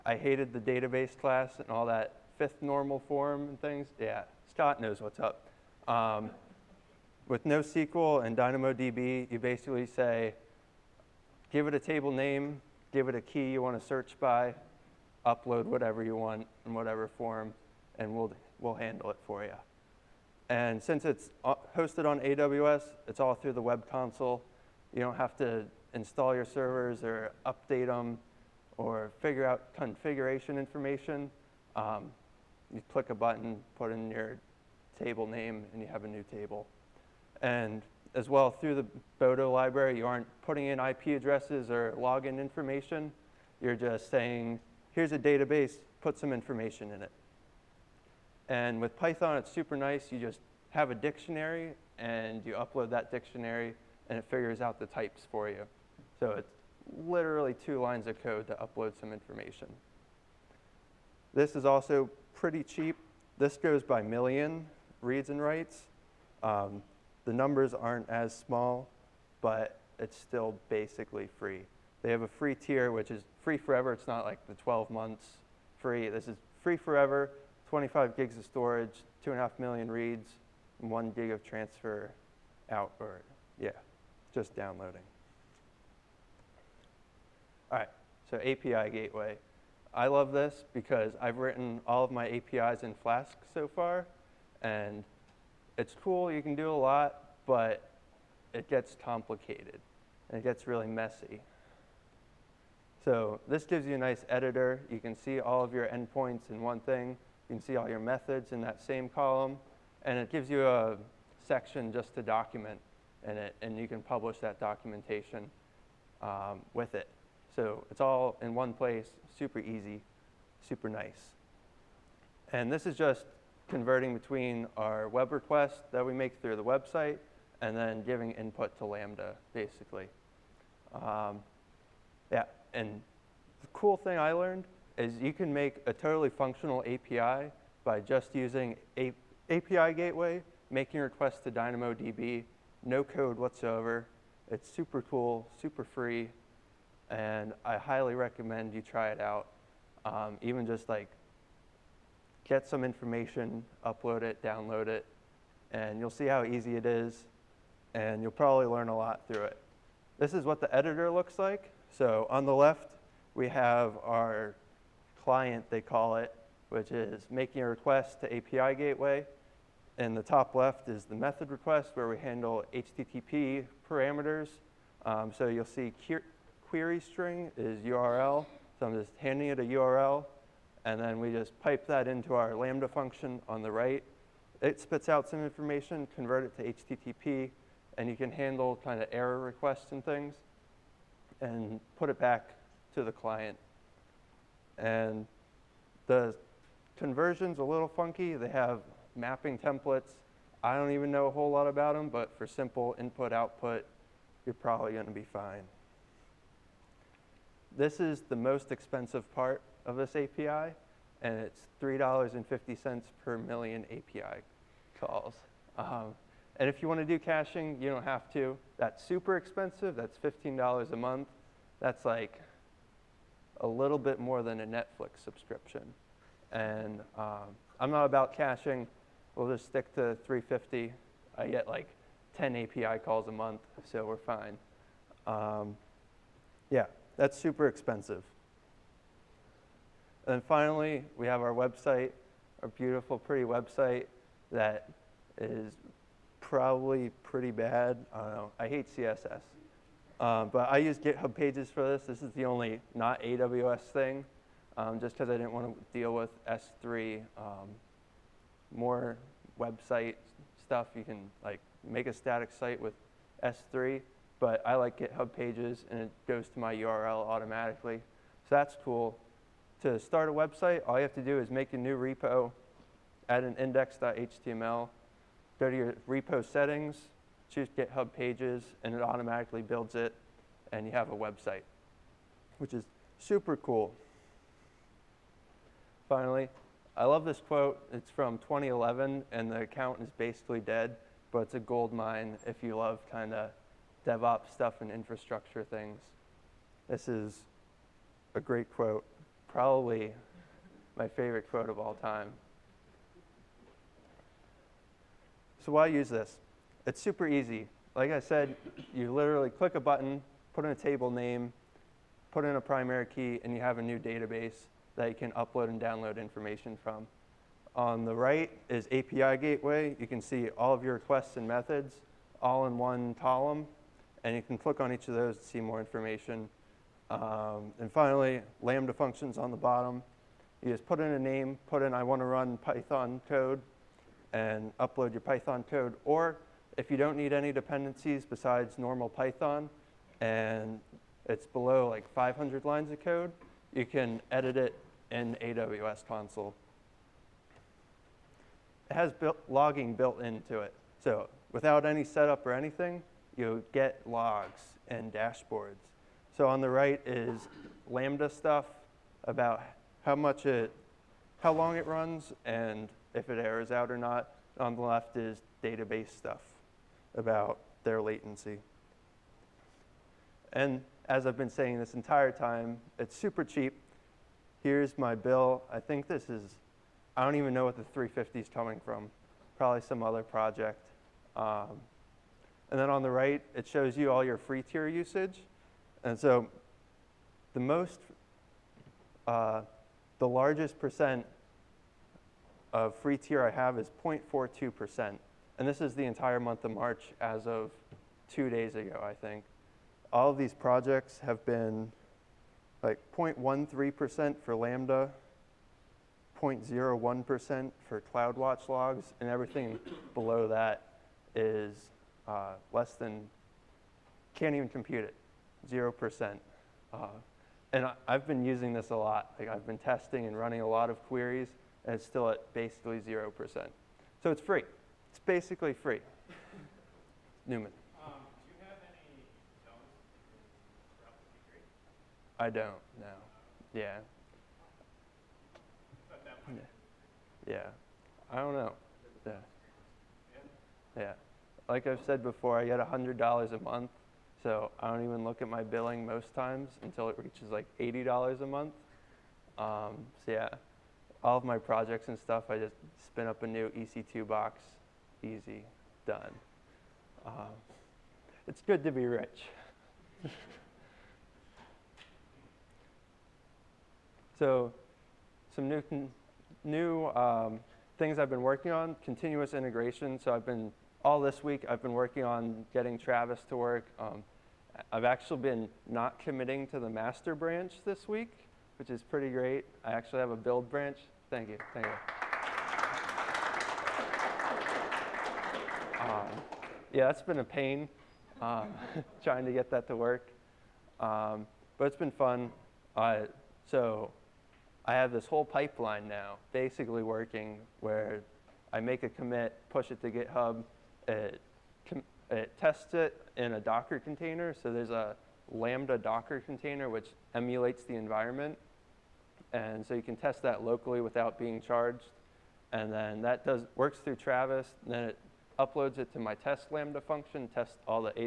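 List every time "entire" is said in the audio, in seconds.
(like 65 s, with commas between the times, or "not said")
371 s, 396 s.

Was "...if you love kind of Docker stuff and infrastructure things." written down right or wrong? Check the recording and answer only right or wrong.
wrong.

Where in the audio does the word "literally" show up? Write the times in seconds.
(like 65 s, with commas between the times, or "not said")
57 s, 309 s.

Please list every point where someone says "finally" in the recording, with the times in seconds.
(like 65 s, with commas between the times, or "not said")
240 s, 286 s, 327 s.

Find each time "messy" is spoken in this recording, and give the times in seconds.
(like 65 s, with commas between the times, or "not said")
100 s.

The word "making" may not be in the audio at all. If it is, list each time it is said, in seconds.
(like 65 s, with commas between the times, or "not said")
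140 s, 167 s.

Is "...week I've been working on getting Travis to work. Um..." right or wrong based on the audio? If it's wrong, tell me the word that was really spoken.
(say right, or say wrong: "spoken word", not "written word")
right.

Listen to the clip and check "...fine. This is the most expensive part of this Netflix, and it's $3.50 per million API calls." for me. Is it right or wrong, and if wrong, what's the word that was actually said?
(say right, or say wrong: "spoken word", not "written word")
wrong: "API", not "Netflix".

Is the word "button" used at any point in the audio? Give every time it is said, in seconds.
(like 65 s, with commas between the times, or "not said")
33 s, 309 s.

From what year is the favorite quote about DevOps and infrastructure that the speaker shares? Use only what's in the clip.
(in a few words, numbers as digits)
2011.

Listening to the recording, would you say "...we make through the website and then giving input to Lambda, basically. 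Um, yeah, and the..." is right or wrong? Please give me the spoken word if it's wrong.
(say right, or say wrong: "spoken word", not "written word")
right.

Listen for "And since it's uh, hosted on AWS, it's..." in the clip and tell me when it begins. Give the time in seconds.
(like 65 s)
20 s.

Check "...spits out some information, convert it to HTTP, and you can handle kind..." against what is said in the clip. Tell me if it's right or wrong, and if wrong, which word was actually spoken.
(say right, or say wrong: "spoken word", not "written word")
right.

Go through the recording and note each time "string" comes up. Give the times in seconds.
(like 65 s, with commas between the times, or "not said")
176 s.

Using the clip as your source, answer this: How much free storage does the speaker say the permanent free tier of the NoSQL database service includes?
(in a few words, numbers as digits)
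25 gigs.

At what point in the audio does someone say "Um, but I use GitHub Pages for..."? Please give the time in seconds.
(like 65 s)
250 s.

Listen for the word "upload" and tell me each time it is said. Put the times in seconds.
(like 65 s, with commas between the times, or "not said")
15 s, 52 s, 58 s, 153 s, 315 s, 334 s, 515 s.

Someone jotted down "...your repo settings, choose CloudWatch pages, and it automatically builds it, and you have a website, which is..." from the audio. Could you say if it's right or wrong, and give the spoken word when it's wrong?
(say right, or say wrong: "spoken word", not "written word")
wrong: "GitHub", not "CloudWatch".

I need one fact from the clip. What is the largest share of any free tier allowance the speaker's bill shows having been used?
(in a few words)
0.42%.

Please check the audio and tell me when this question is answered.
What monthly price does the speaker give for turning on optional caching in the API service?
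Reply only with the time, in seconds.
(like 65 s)
220 s.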